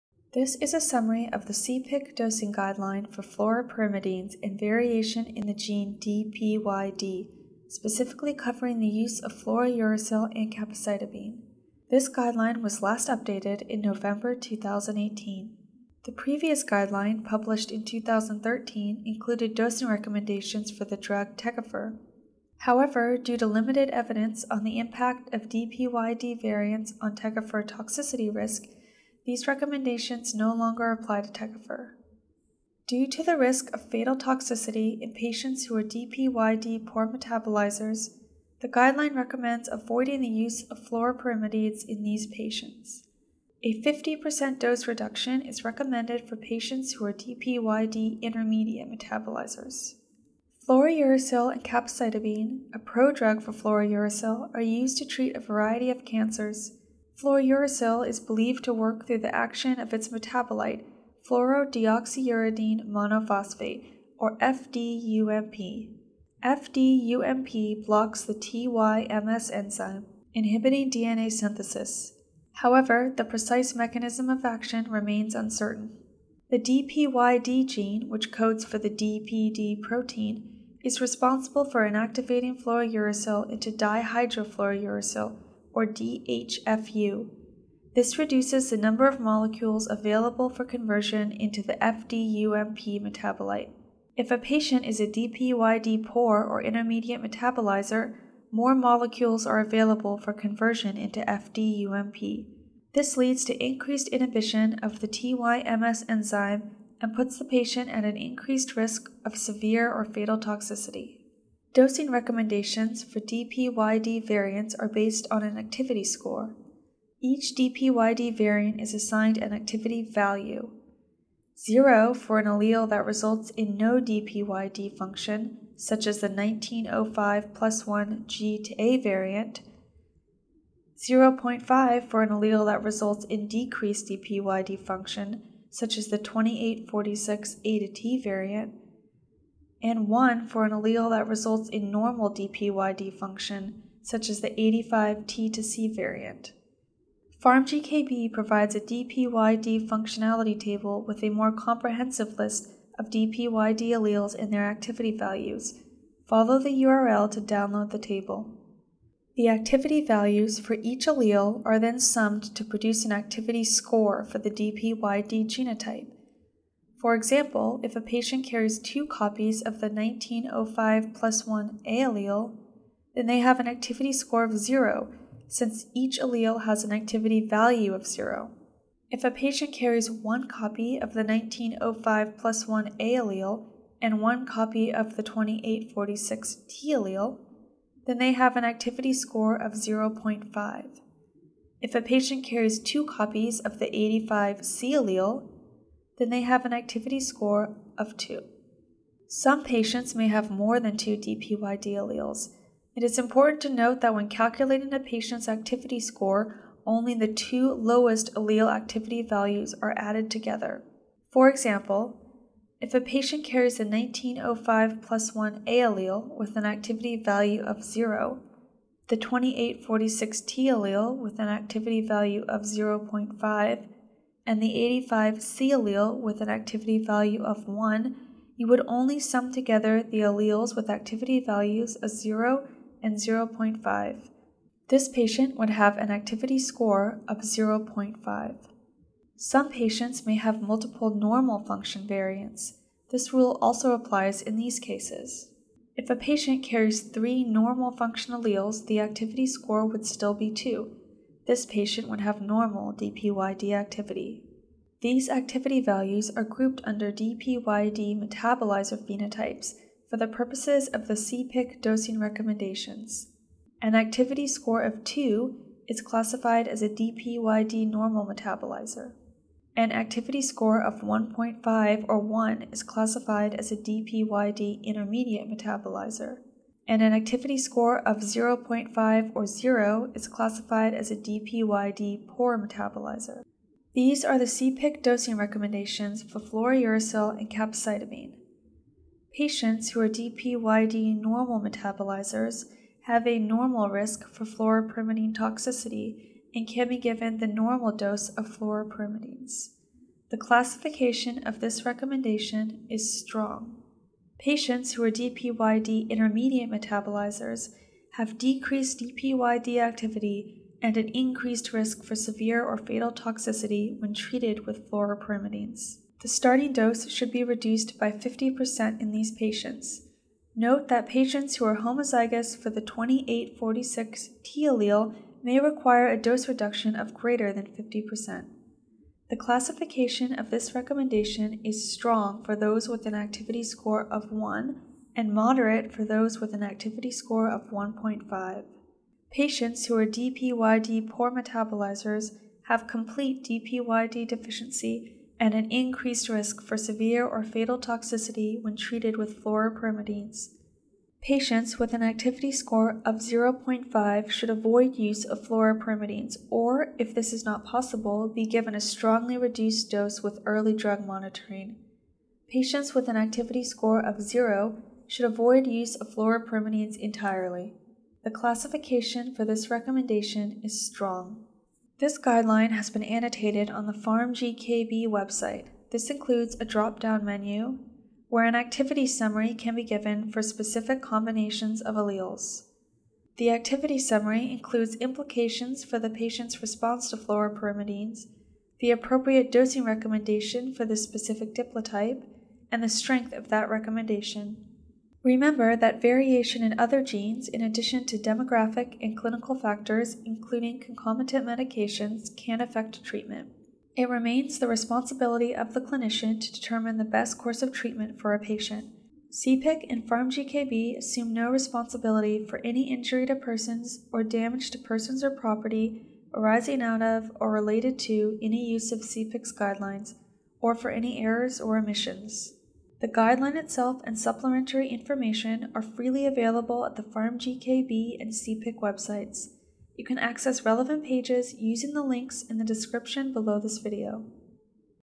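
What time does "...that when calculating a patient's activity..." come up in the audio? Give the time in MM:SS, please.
03:24.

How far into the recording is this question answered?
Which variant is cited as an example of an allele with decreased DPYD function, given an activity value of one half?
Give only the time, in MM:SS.
02:16.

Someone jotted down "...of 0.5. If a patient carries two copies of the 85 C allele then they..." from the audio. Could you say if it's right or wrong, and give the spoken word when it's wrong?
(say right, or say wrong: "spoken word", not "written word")
right.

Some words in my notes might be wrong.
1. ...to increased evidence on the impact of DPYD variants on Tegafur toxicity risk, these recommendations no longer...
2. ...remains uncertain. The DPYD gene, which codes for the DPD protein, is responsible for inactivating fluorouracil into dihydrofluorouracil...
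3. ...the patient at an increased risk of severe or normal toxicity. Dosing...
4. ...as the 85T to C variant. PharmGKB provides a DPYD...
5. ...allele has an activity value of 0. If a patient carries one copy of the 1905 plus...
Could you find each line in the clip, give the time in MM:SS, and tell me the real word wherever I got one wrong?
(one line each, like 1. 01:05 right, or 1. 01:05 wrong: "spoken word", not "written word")
1. 00:23 wrong: "limited", not "increased"
2. 01:14 right
3. 01:47 wrong: "fatal", not "normal"
4. 02:24 right
5. 02:56 right.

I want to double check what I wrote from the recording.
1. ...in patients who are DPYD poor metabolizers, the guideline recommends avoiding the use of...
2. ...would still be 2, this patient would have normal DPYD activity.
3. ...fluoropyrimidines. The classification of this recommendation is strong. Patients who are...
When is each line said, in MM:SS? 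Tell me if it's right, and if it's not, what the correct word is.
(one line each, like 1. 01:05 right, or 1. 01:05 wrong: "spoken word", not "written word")
1. 00:34 right
2. 04:09 right
3. 04:58 right.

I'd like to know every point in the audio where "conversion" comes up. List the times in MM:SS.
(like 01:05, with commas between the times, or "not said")
01:30, 01:40.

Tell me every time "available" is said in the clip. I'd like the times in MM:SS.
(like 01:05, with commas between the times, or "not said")
01:29, 01:39, 07:06.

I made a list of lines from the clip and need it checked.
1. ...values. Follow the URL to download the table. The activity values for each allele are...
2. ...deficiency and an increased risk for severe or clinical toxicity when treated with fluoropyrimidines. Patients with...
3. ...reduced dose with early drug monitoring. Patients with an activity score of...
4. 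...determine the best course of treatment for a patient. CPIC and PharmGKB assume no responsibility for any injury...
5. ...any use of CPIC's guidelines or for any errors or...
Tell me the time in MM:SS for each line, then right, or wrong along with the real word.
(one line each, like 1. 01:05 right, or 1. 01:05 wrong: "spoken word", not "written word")
1. 02:35 right
2. 05:44 wrong: "fatal", not "clinical"
3. 05:59 right
4. 06:46 right
5. 06:58 right.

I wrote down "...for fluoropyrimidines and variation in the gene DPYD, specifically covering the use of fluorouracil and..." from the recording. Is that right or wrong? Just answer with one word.
right.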